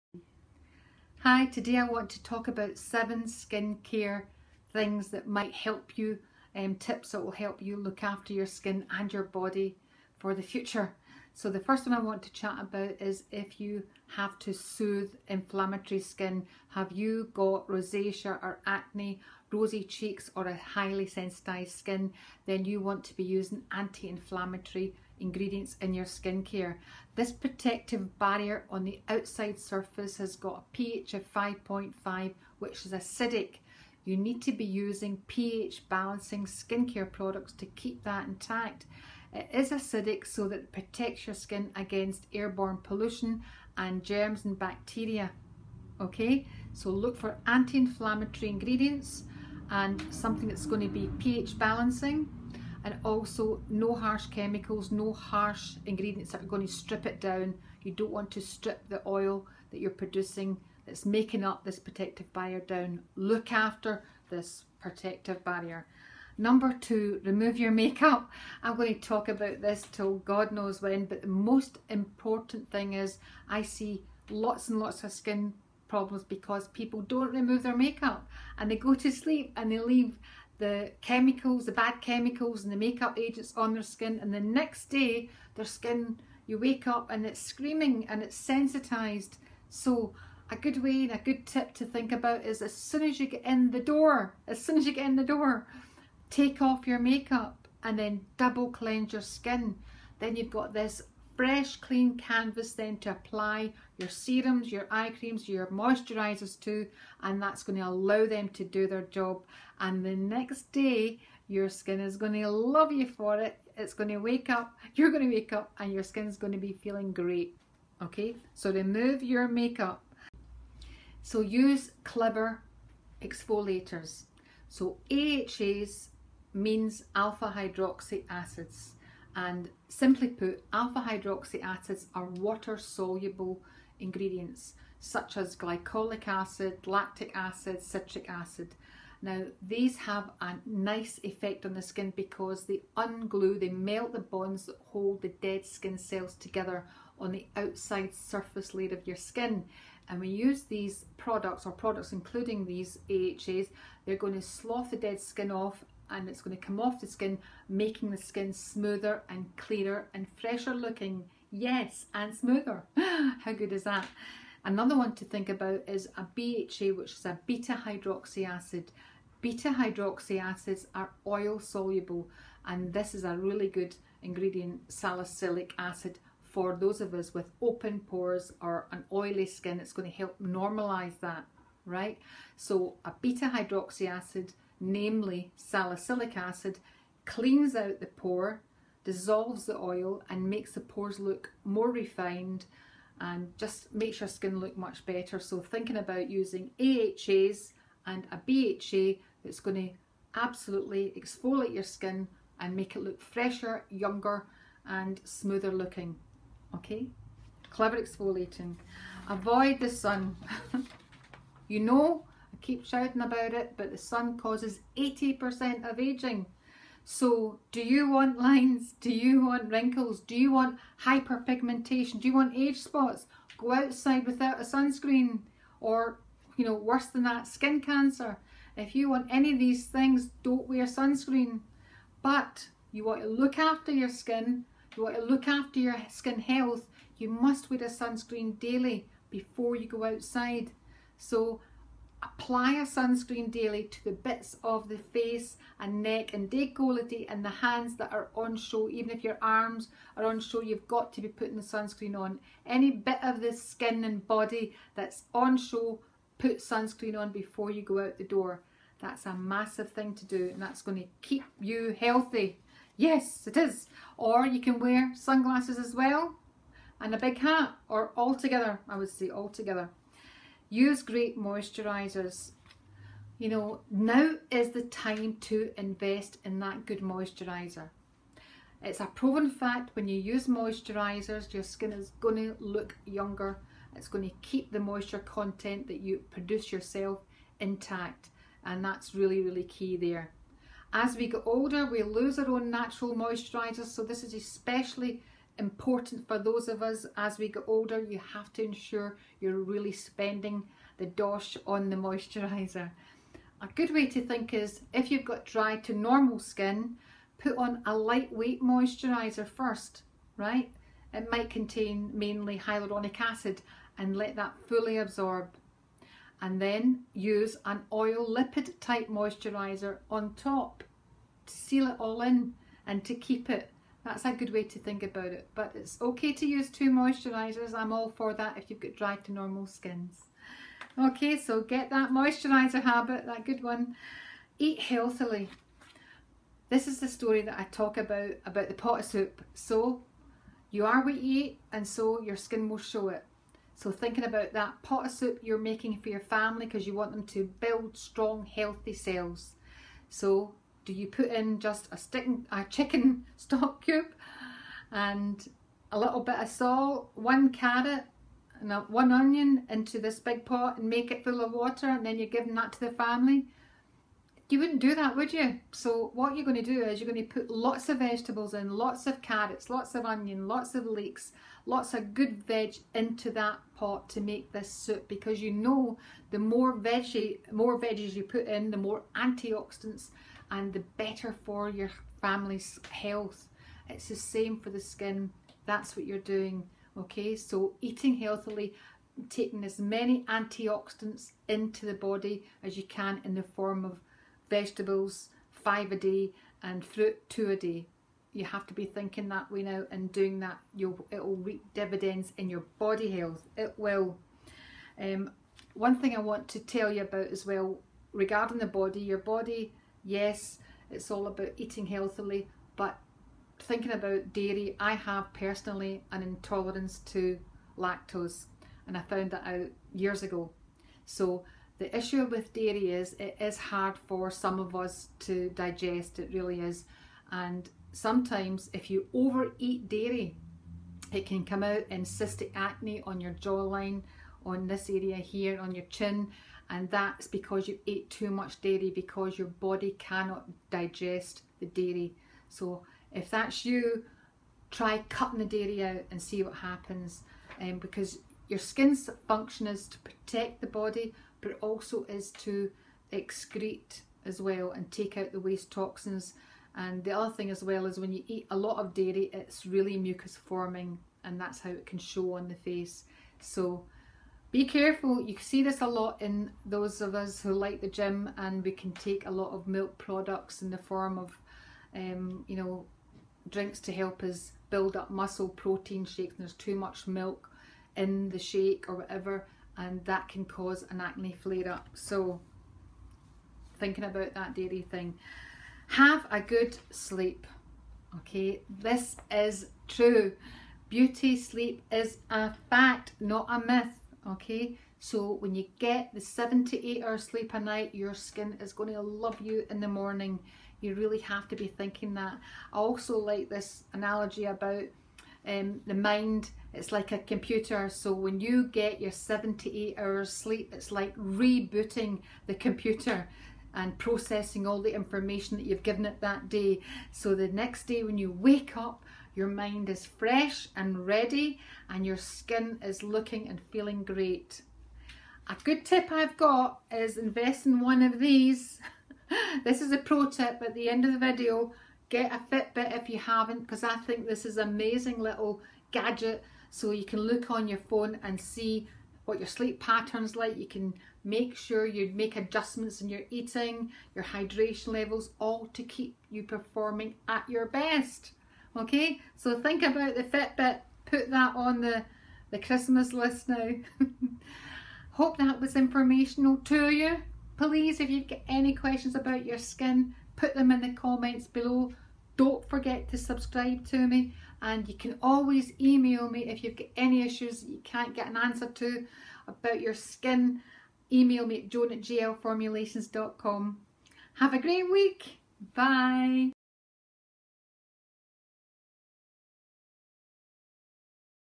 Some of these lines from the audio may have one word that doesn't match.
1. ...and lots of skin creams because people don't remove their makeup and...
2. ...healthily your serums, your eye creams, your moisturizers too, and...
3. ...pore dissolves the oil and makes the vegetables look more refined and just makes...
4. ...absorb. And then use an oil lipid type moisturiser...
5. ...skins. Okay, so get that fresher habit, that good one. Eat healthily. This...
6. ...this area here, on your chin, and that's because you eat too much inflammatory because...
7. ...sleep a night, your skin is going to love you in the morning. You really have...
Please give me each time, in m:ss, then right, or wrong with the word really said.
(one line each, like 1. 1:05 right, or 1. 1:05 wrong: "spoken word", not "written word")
1. 1:14 wrong: "problems", not "creams"
2. 1:43 wrong: "apply", not "healthily"
3. 3:08 wrong: "pores", not "vegetables"
4. 5:14 right
5. 5:29 wrong: "moisturiser", not "fresher"
6. 7:14 wrong: "dairy", not "inflammatory"
7. 8:17 right.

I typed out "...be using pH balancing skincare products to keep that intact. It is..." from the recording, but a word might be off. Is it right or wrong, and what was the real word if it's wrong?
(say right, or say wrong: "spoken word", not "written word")
right.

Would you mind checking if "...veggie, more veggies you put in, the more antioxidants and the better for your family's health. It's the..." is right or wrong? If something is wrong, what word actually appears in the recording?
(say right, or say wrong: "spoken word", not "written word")
right.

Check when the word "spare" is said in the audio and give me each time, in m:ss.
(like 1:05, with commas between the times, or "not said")
not said.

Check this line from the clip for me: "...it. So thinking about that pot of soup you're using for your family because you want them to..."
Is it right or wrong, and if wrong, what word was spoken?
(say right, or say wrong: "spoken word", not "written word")
wrong: "making", not "using".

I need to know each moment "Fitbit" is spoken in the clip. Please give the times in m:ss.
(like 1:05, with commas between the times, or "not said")
8:52, 9:10.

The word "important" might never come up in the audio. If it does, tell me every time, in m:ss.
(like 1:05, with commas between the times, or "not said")
1:11, 4:55.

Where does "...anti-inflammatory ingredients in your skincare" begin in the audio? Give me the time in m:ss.
0:23.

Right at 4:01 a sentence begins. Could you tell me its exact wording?
So Apply a sunscreen daily to the bits of the face and neck and decollete and the hands that are on show.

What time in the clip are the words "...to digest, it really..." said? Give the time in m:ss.
7:05.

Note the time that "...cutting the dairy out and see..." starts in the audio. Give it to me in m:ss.
7:25.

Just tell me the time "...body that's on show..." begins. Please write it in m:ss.
4:14.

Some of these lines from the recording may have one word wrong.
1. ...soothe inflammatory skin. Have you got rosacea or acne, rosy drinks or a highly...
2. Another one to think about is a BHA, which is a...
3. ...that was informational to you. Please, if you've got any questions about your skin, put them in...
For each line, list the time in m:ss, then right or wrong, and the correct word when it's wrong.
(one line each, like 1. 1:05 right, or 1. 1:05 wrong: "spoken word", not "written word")
1. 0:14 wrong: "cheeks", not "drinks"
2. 2:44 right
3. 9:15 right.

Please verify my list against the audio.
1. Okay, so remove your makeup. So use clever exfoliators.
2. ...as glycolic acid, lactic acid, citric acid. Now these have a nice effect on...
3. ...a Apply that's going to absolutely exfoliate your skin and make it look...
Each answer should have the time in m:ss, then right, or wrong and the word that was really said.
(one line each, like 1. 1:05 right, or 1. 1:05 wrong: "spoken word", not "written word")
1. 1:58 right
2. 2:15 right
3. 3:18 wrong: "BHA", not "Apply".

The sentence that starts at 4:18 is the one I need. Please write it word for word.
That's a massive thing to do and that's going to keep you healthy.